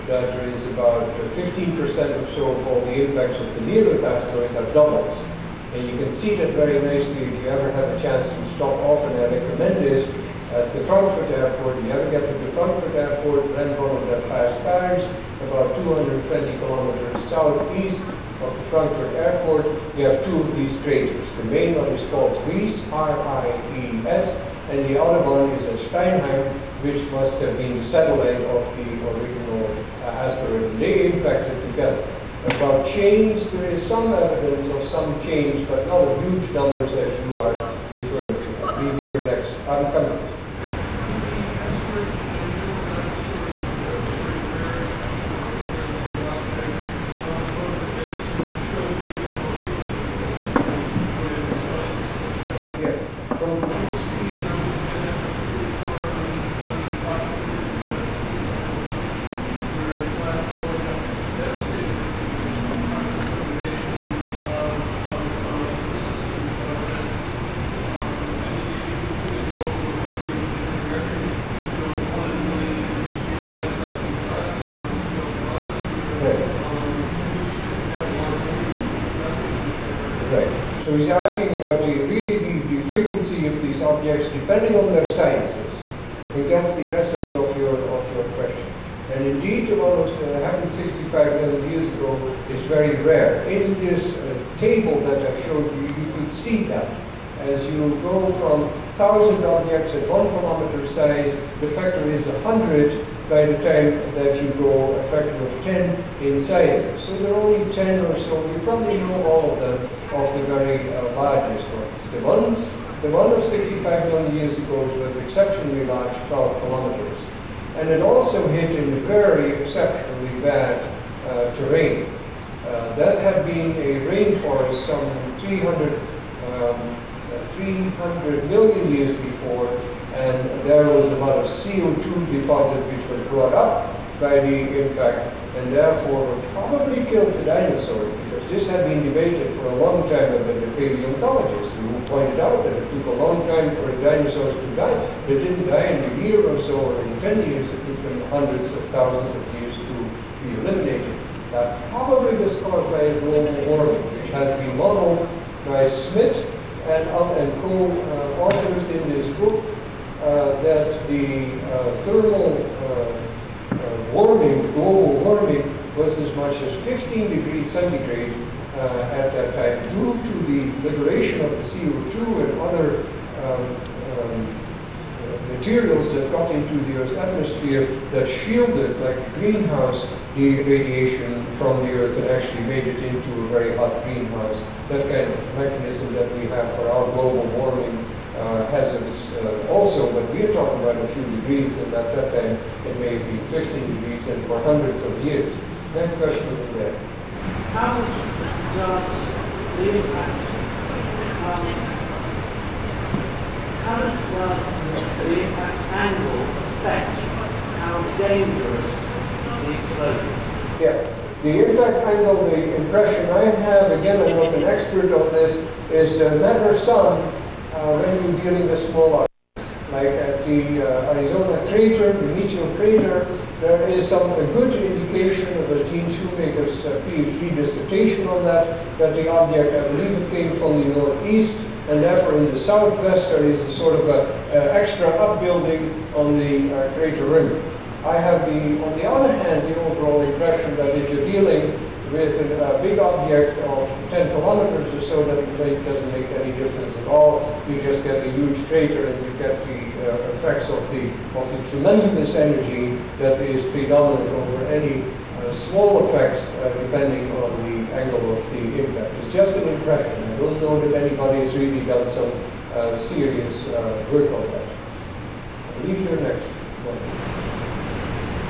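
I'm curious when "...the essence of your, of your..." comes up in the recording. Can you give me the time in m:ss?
1:26.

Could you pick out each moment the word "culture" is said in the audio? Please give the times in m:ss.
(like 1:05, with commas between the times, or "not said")
not said.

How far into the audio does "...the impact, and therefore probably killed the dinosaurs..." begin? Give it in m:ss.
2:14.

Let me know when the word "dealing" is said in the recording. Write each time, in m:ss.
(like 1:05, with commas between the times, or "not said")
3:38, 4:01.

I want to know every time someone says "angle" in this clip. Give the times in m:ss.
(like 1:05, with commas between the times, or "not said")
3:25, 3:32, 4:17.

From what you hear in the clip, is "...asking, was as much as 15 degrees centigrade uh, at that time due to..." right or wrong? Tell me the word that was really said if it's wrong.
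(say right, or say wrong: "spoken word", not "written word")
wrong: "warming", not "asking".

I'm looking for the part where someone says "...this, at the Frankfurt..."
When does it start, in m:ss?
0:09.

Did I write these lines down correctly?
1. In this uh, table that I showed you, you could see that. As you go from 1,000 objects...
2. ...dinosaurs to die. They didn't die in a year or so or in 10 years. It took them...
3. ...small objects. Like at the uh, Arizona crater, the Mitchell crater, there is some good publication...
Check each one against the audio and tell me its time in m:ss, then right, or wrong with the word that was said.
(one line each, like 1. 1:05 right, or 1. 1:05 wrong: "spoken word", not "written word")
1. 1:33 right
2. 2:24 right
3. 3:38 right.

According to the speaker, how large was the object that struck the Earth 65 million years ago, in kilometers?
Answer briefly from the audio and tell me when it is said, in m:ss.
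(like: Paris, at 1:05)
12 kilometers, at 1:56.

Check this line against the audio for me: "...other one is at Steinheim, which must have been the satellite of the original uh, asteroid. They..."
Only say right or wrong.
right.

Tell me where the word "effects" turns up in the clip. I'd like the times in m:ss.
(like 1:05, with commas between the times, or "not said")
4:10, 4:16.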